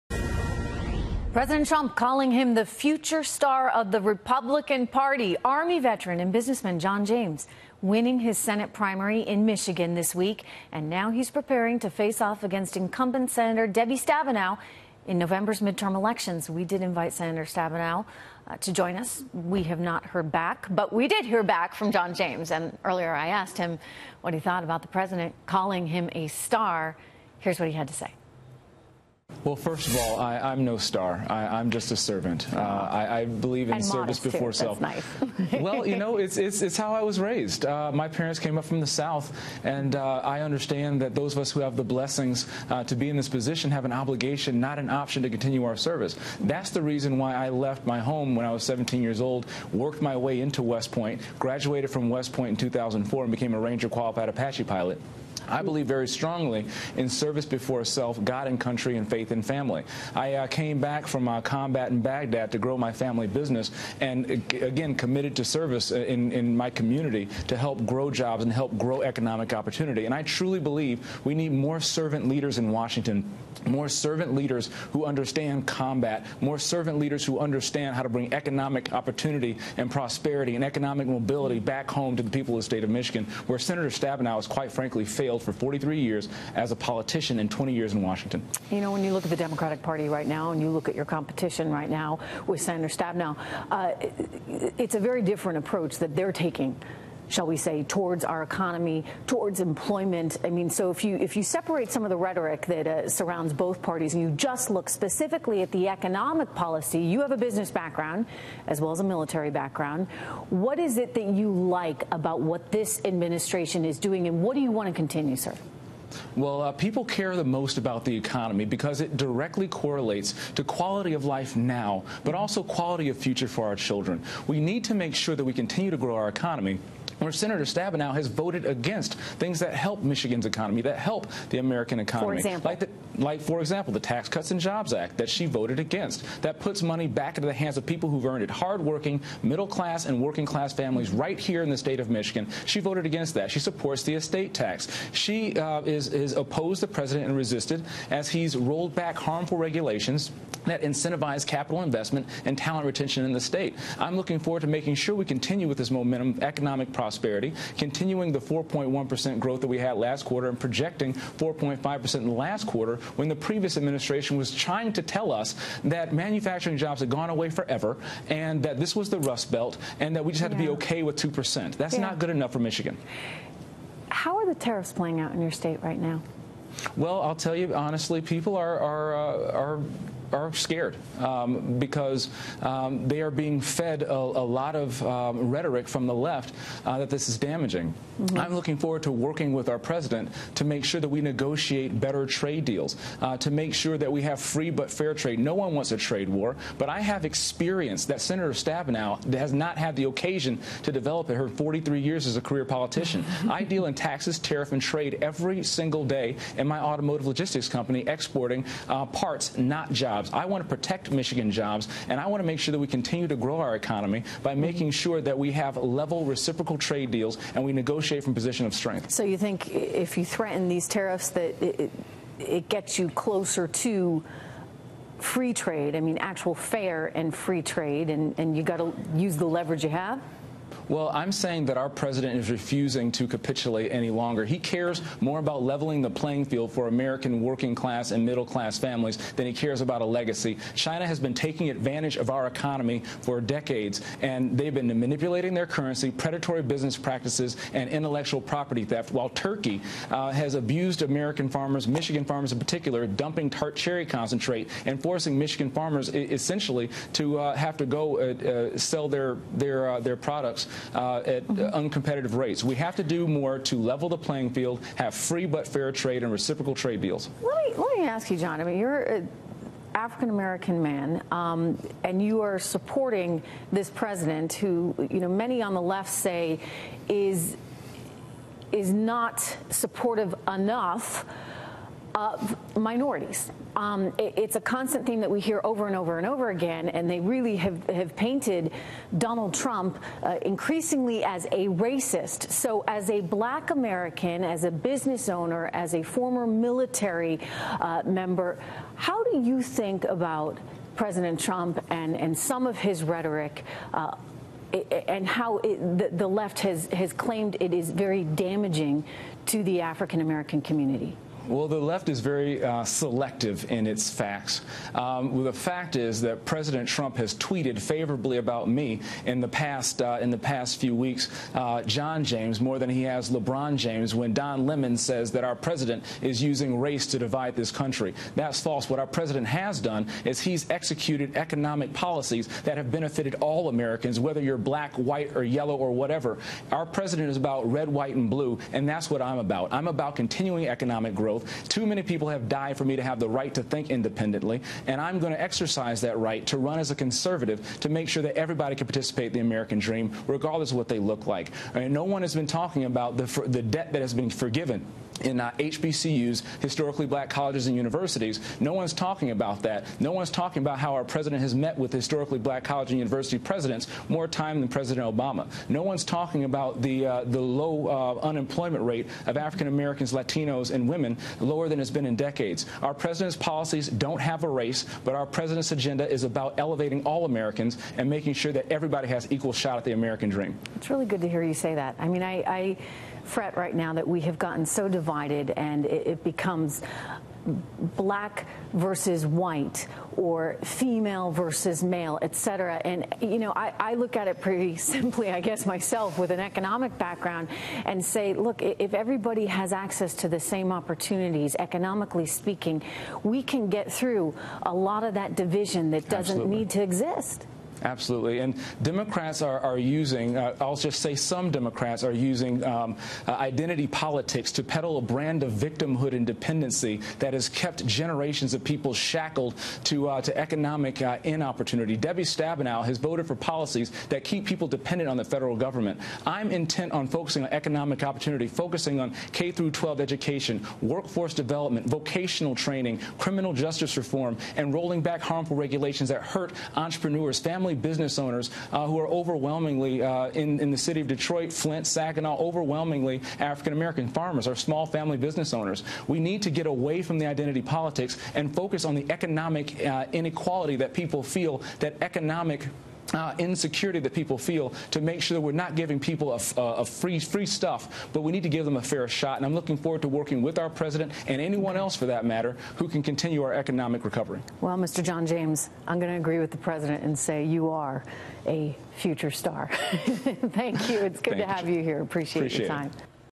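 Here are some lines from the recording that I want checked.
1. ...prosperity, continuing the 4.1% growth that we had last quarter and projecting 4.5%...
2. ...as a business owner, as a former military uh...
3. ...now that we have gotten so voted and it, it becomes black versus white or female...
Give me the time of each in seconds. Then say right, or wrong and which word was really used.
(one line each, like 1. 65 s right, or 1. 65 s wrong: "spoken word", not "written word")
1. 156 s right
2. 294 s right
3. 383 s wrong: "divided", not "voted".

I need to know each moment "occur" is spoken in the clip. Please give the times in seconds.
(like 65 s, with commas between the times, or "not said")
not said.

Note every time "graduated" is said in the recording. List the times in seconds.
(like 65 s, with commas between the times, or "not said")
51 s.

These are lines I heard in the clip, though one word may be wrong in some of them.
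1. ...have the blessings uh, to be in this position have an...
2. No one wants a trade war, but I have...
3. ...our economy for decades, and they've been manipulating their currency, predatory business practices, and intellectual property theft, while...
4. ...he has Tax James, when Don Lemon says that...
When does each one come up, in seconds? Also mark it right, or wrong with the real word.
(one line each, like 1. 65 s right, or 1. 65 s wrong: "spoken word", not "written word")
1. 41 s right
2. 195 s right
3. 242 s right
4. 322 s wrong: "LeBron", not "Tax".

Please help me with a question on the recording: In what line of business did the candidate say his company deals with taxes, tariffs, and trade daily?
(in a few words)
automotive logistics.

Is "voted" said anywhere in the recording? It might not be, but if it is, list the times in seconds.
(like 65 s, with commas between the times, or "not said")
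128 s, 135 s, 142 s, 422 s.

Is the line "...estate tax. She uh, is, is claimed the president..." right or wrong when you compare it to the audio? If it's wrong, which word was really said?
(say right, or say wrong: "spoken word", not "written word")
wrong: "opposed", not "claimed".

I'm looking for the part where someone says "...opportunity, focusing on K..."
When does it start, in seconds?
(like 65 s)
428 s.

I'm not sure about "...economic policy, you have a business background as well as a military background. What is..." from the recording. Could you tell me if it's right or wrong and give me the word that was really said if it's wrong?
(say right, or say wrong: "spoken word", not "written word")
right.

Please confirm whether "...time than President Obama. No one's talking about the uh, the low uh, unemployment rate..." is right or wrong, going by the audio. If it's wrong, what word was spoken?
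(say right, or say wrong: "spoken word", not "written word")
right.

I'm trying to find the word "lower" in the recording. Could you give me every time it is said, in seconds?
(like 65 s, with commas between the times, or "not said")
371 s.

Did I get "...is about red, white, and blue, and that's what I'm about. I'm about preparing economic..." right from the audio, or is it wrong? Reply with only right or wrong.
wrong.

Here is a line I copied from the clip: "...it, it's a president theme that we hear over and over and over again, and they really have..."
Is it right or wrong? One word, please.
wrong.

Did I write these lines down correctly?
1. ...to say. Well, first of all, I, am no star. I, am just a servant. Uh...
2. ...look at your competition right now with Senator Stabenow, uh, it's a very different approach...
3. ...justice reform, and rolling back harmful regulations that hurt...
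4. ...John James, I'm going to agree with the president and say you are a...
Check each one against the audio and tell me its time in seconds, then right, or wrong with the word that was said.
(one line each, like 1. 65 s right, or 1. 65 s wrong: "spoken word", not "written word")
1. 27 s right
2. 90 s right
3. 433 s right
4. 465 s right.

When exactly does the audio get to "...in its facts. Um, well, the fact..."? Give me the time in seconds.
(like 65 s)
313 s.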